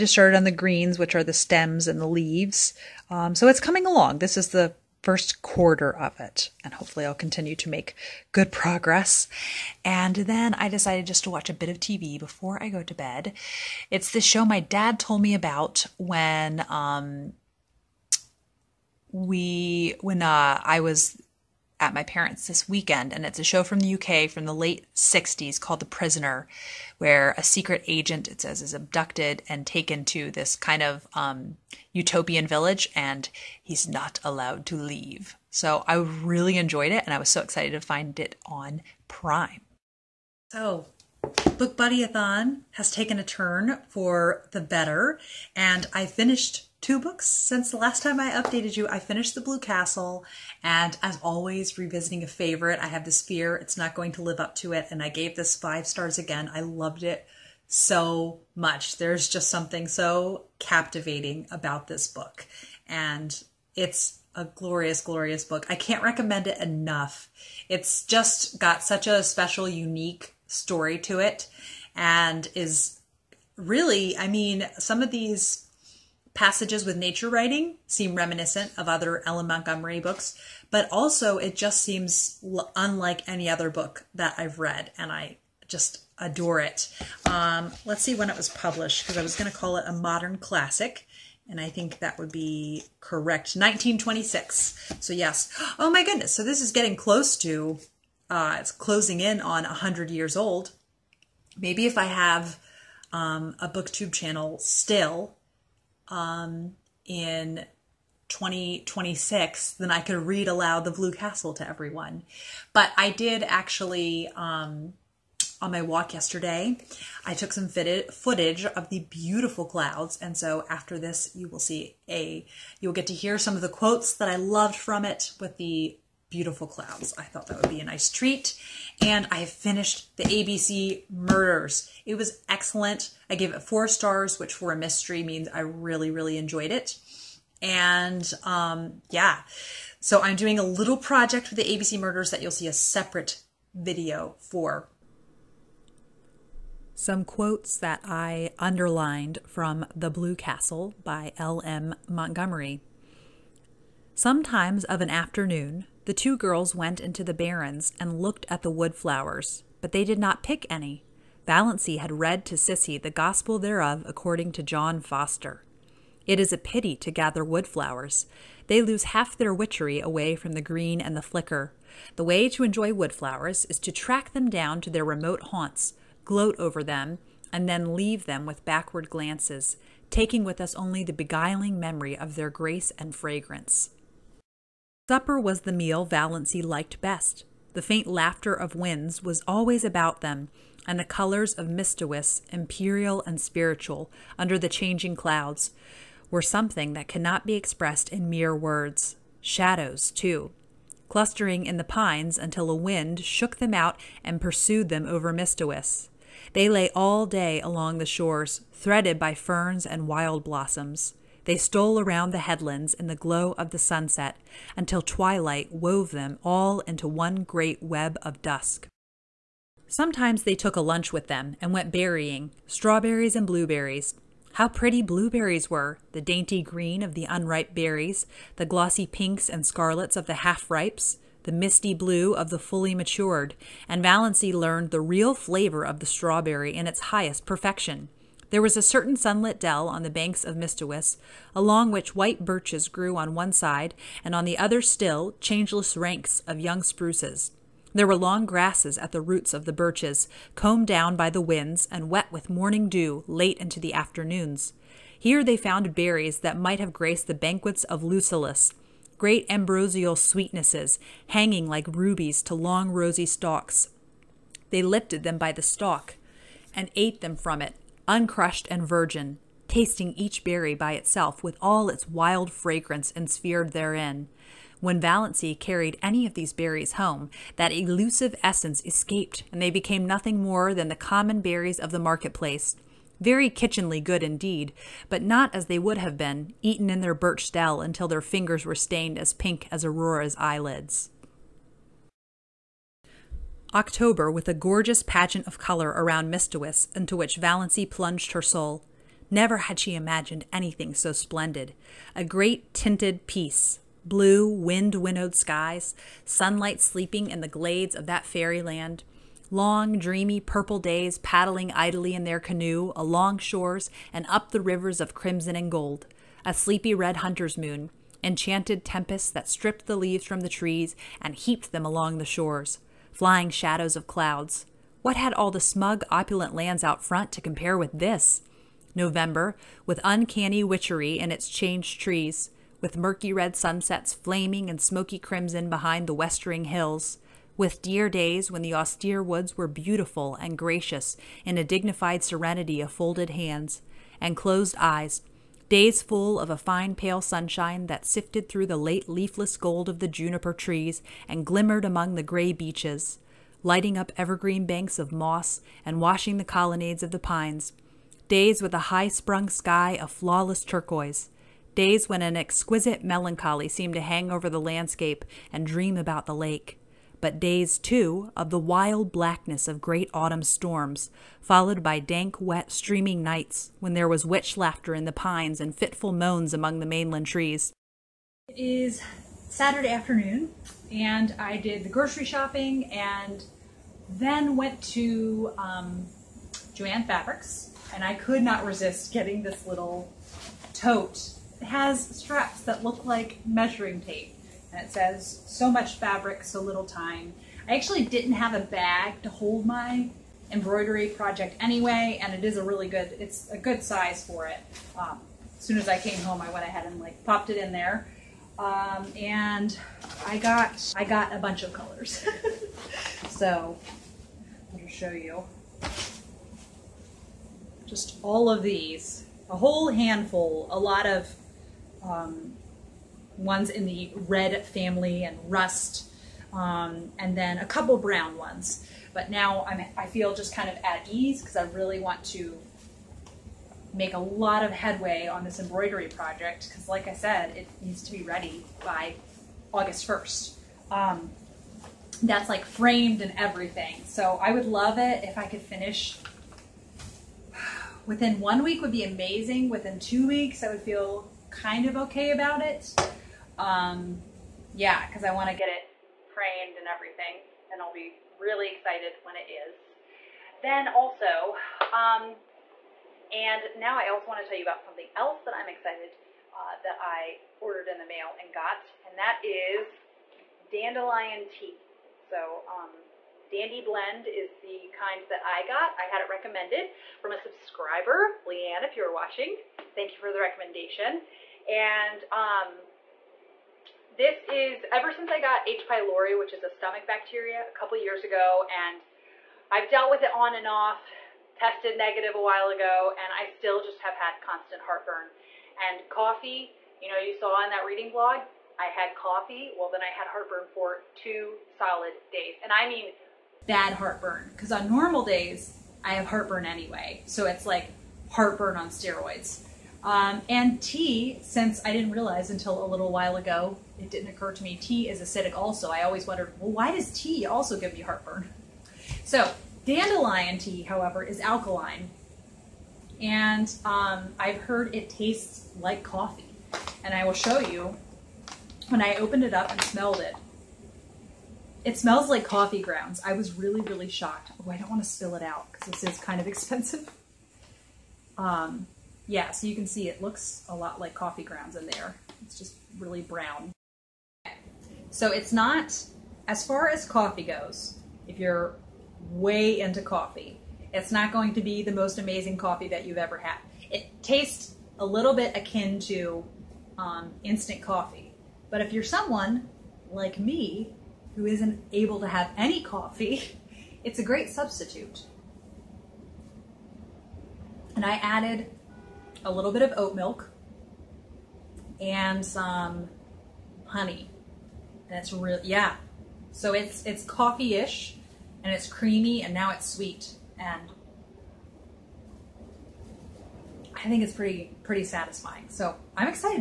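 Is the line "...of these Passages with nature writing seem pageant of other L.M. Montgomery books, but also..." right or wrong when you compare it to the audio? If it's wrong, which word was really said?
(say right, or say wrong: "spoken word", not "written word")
wrong: "reminiscent", not "pageant".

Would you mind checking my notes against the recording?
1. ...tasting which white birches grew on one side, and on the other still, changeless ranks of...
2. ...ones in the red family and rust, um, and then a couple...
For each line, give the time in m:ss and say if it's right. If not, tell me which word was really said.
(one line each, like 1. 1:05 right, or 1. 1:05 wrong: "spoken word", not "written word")
1. 4:01 wrong: "along", not "tasting"
2. 7:03 right.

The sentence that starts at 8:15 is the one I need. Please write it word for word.
And coffee, you know, you saw in that reading blog, I had coffee.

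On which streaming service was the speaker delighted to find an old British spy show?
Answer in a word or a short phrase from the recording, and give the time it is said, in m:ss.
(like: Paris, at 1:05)
Prime, at 0:39.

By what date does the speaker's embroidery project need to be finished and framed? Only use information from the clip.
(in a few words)
August 1st.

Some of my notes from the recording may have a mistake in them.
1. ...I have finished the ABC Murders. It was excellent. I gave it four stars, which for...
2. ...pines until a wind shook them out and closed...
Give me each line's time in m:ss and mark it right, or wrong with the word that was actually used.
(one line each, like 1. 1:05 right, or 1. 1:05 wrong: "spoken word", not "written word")
1. 2:09 right
2. 3:21 wrong: "pursued", not "closed".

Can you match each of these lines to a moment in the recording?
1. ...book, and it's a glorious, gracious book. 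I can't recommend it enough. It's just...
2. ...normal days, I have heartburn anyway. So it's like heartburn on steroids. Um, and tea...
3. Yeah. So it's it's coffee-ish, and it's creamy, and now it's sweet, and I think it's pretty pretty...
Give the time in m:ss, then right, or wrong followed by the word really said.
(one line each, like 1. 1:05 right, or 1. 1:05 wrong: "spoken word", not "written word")
1. 1:02 wrong: "glorious", not "gracious"
2. 8:24 right
3. 9:35 right.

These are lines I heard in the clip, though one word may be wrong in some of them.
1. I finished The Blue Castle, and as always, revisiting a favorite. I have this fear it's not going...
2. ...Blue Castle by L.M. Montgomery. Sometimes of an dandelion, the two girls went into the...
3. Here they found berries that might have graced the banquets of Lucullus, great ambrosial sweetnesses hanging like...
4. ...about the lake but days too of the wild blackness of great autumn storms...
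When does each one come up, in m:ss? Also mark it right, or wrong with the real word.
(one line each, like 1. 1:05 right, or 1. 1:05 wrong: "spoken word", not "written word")
1. 0:48 right
2. 2:30 wrong: "afternoon", not "dandelion"
3. 4:15 right
4. 6:05 right.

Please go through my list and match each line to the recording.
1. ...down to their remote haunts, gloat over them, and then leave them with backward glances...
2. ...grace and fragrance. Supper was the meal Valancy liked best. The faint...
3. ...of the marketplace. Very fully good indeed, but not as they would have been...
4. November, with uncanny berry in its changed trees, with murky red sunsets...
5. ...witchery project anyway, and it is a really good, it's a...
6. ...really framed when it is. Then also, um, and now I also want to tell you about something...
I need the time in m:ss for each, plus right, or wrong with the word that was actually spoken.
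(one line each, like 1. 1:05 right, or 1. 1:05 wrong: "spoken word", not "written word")
1. 2:54 right
2. 3:02 right
3. 4:41 wrong: "kitchenly", not "fully"
4. 5:28 wrong: "witchery", not "berry"
5. 6:40 wrong: "embroidery", not "witchery"
6. 7:38 wrong: "excited", not "framed".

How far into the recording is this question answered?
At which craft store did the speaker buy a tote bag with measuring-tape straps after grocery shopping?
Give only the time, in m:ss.
6:26.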